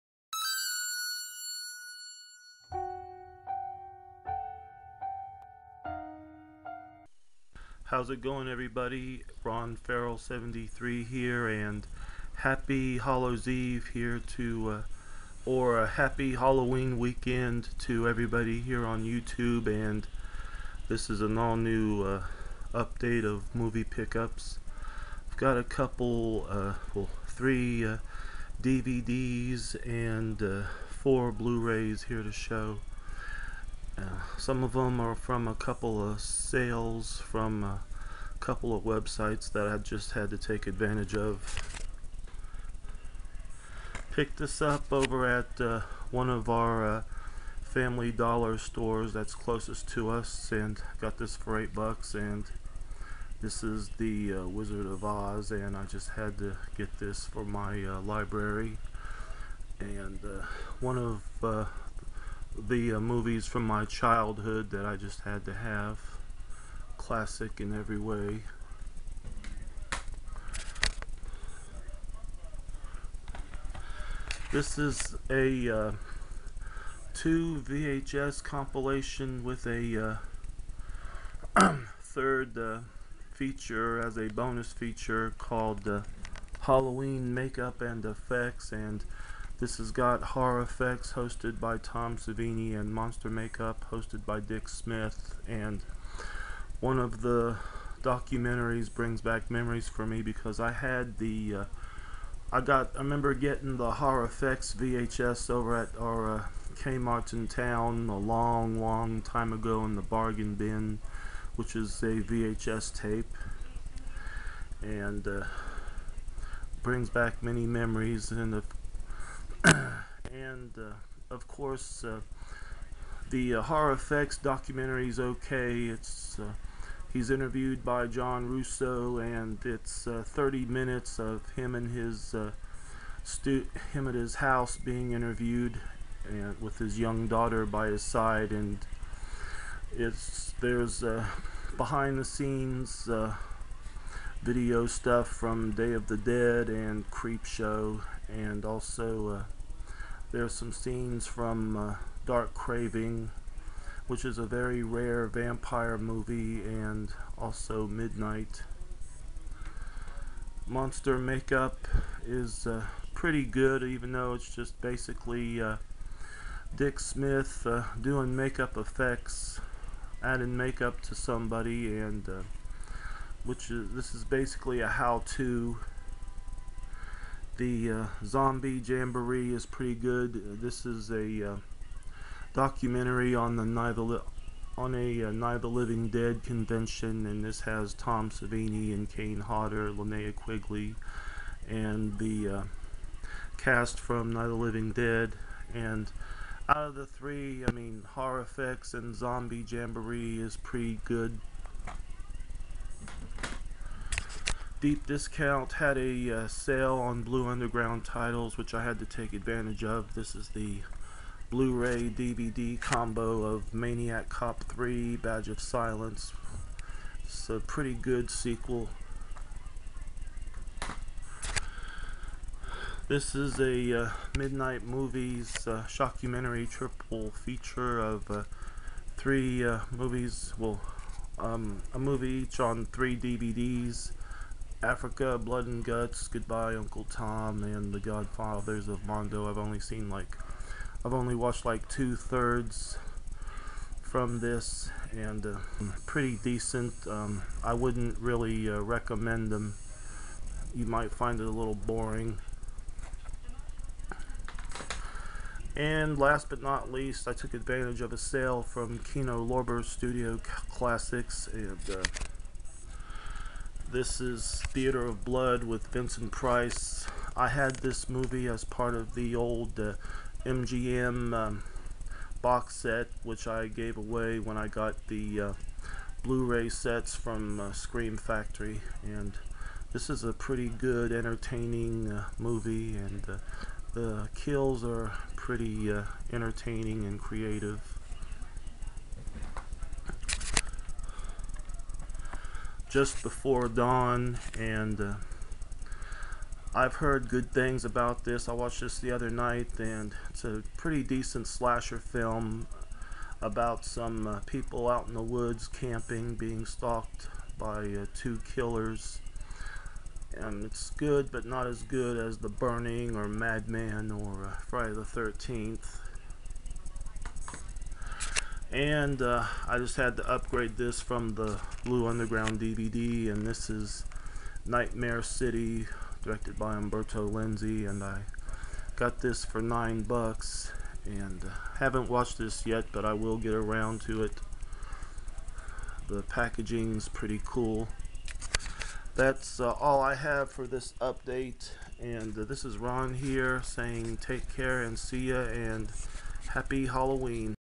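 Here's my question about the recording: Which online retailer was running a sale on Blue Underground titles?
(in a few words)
Deep Discount.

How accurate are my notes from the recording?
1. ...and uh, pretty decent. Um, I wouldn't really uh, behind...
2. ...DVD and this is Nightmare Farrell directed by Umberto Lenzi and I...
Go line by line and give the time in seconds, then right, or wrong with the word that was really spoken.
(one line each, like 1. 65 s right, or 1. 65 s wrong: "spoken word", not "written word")
1. 245 s wrong: "recommend", not "behind"
2. 322 s wrong: "City", not "Farrell".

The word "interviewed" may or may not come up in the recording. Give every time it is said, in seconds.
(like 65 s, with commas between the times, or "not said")
127 s, 135 s.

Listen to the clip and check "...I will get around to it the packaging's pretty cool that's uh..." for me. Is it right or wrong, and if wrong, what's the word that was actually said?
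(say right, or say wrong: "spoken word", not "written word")
right.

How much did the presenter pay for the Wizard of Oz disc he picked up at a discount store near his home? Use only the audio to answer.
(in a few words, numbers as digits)
$8.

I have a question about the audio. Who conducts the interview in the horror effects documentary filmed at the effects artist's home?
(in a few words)
John Russo.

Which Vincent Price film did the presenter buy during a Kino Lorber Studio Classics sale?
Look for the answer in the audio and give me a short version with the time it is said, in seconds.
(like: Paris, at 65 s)
Theater of Blood, at 264 s.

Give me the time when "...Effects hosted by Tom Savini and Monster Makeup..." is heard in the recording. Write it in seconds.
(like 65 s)
90 s.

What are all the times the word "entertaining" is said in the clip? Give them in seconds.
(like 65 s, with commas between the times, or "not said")
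281 s, 286 s.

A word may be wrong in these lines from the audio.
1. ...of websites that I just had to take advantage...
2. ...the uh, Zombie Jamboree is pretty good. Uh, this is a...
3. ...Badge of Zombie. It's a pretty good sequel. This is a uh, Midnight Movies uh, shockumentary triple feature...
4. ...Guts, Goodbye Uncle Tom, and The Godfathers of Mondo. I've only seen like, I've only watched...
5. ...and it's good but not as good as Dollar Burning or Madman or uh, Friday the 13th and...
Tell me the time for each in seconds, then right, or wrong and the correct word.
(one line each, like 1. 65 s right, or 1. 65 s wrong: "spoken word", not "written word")
1. 38 s right
2. 177 s right
3. 215 s wrong: "Silence", not "Zombie"
4. 235 s right
5. 310 s wrong: "The", not "Dollar".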